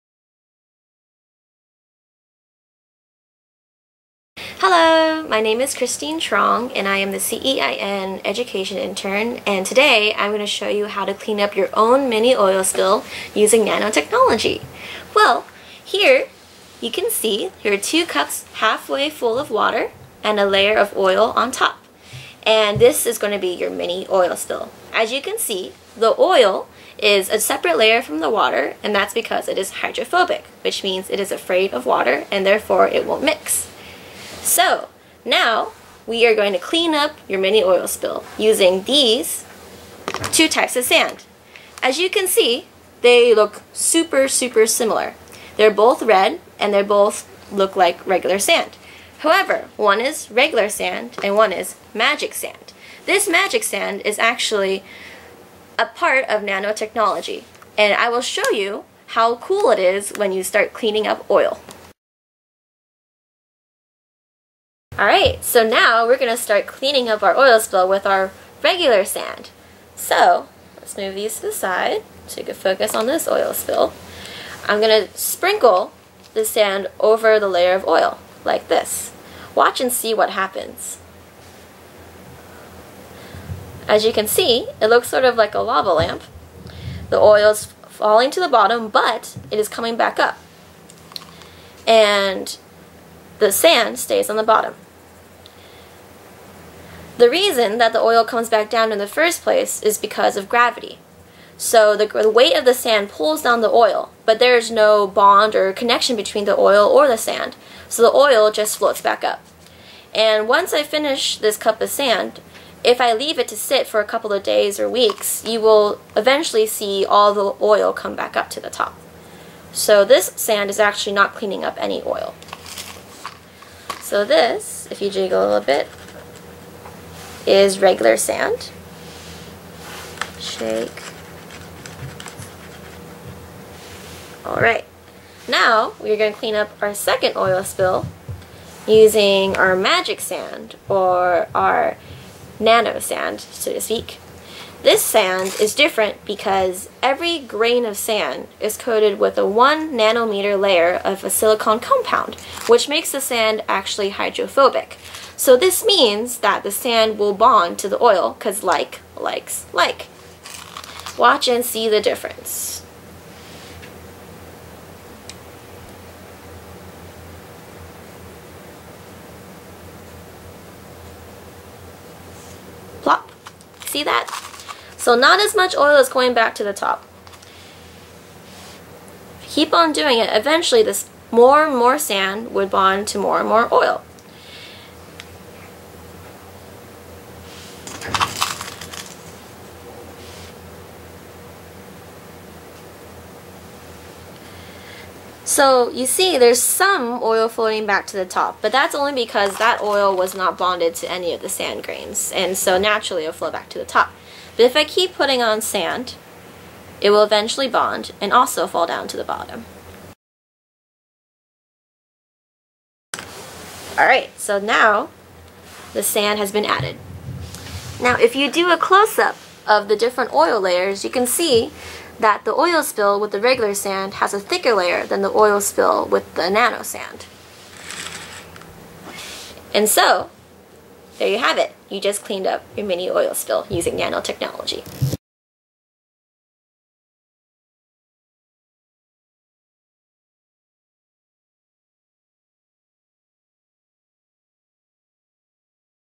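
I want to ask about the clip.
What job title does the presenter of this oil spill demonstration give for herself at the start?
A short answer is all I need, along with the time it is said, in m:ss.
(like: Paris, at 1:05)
CEIN Education Intern, at 0:07.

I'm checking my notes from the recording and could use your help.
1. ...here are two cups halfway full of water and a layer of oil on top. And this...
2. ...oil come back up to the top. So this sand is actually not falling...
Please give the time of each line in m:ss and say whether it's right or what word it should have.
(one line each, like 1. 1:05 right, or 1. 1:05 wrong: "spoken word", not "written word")
1. 0:17 right
2. 1:57 wrong: "cleaning", not "falling".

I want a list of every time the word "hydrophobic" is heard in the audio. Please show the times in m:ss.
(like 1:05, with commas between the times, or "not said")
0:29, 2:34.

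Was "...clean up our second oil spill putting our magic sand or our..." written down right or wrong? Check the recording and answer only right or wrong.
wrong.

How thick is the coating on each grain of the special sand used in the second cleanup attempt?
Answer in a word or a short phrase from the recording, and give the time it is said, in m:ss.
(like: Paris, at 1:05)
1 nanometer, at 2:29.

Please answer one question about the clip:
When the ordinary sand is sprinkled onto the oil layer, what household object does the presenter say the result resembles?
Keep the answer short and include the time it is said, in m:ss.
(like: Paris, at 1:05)
a lava lamp, at 1:25.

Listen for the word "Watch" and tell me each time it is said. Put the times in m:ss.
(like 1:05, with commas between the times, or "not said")
1:19, 2:41.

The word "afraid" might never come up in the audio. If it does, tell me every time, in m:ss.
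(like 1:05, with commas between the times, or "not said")
0:31.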